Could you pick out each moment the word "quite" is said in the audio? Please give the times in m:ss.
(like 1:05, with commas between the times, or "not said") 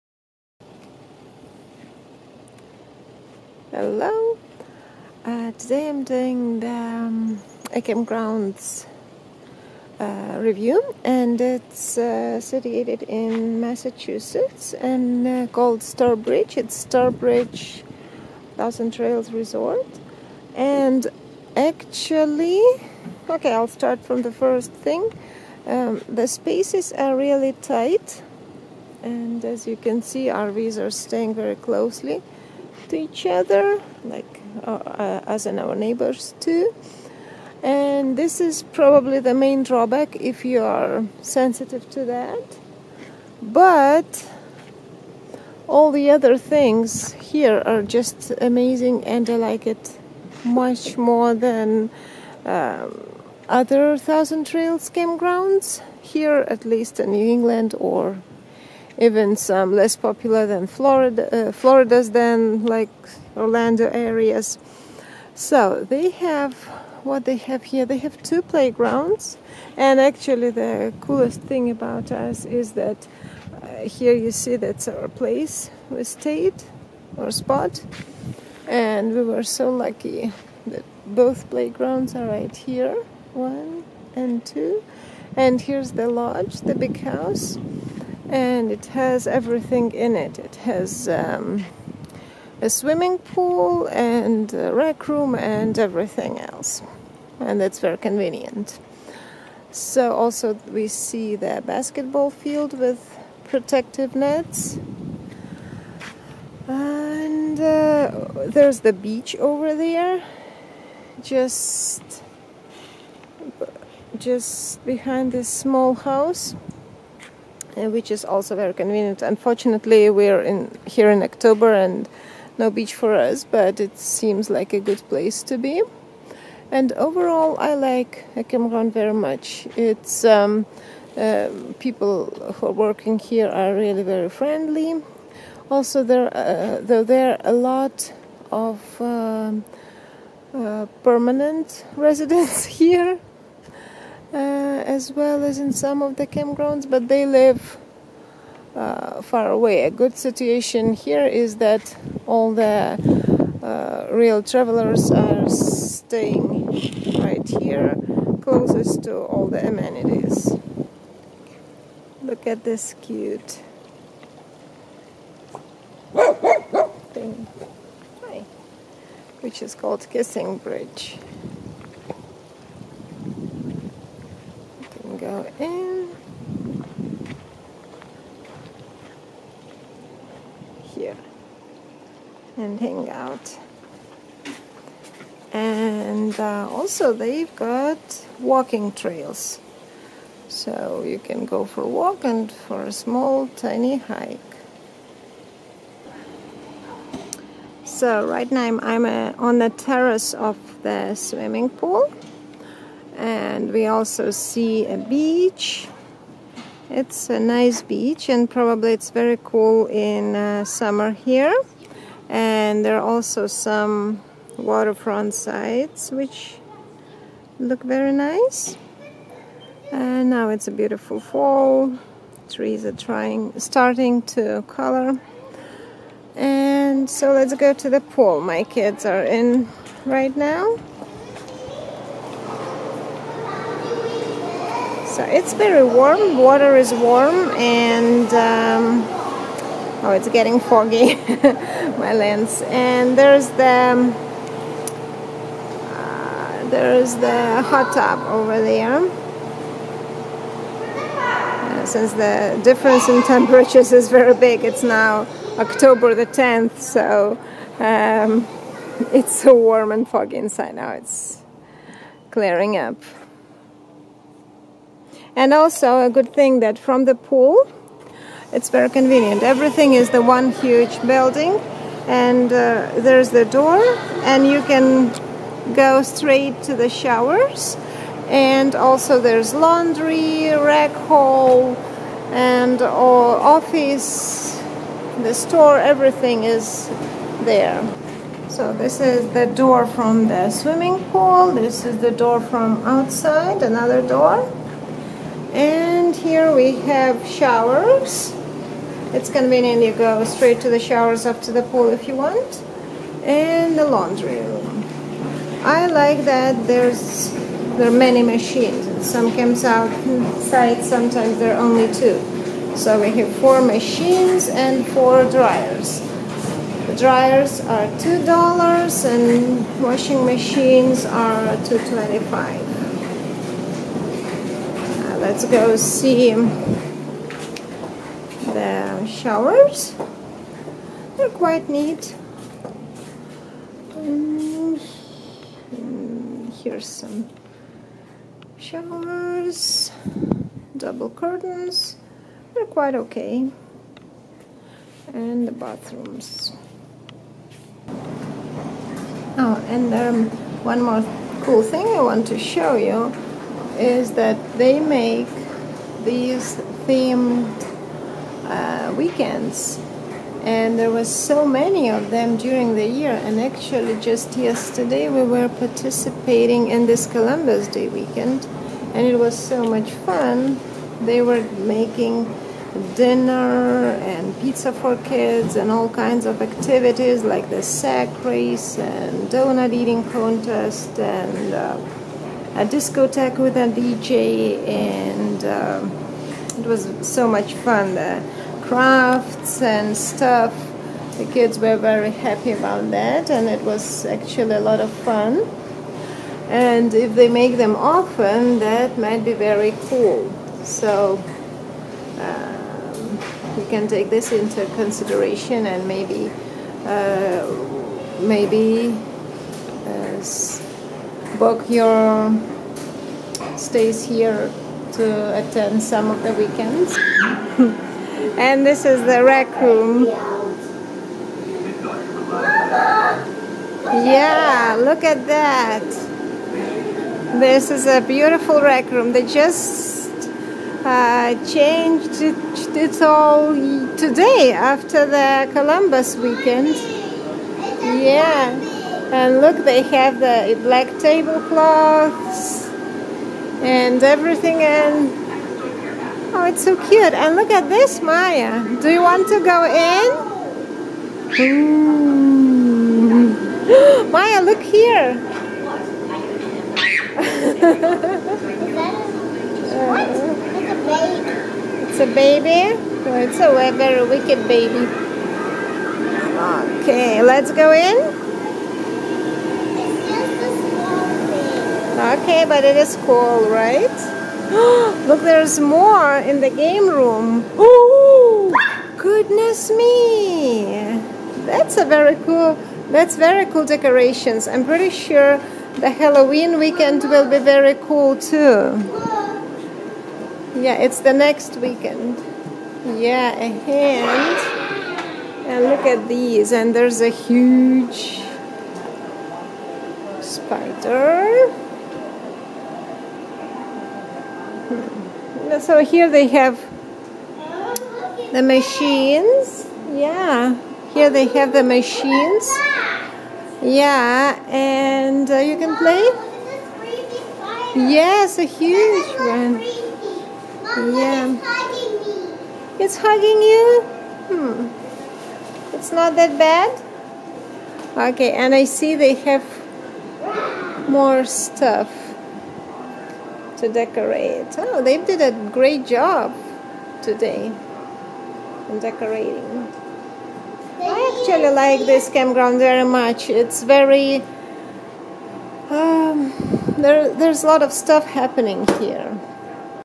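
5:31, 5:42.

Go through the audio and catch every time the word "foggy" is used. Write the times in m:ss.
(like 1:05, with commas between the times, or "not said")
4:00, 4:20.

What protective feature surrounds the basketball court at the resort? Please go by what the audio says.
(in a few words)
Nets.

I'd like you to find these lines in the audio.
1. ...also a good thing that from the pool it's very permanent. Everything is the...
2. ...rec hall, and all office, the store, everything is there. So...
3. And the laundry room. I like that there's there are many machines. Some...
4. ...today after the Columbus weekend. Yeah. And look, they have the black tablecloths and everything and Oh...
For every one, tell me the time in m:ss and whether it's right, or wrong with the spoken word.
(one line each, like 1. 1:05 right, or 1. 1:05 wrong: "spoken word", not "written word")
1. 4:25 wrong: "convenient", not "permanent"
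2. 4:40 right
3. 5:03 right
4. 7:13 right.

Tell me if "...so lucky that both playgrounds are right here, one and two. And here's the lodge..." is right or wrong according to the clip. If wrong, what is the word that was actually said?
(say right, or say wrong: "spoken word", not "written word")
right.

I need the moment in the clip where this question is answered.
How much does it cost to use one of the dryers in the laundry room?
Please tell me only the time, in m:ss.
5:17.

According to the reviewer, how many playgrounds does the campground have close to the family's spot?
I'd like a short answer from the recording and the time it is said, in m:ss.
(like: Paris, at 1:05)
2, at 1:08.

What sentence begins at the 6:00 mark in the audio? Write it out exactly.
And there was so many of them during the year.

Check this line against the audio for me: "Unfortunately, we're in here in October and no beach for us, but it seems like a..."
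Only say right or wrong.
right.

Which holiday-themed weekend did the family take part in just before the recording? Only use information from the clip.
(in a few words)
Columbus Day weekend.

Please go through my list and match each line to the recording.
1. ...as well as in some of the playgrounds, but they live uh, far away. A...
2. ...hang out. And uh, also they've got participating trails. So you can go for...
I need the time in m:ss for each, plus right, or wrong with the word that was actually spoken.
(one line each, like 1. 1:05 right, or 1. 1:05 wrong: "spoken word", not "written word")
1. 2:24 wrong: "campgrounds", not "playgrounds"
2. 3:02 wrong: "walking", not "participating".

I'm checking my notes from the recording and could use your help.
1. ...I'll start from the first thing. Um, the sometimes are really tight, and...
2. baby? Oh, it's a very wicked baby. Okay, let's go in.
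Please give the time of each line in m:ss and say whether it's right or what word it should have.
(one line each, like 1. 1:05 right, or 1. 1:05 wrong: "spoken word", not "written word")
1. 0:23 wrong: "spaces", not "sometimes"
2. 7:42 right.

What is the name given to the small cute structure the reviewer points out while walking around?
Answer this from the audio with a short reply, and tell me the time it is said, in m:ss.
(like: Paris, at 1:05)
Kissing Bridge, at 2:50.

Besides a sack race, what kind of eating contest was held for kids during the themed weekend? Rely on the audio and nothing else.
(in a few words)
Donut eating contest.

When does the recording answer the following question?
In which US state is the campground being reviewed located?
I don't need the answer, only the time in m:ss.
0:13.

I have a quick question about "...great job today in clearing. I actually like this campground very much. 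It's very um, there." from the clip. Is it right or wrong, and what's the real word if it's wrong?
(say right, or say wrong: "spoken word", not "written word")
wrong: "decorating", not "clearing".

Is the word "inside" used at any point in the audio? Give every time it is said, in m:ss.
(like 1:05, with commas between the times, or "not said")
4:20, 5:09.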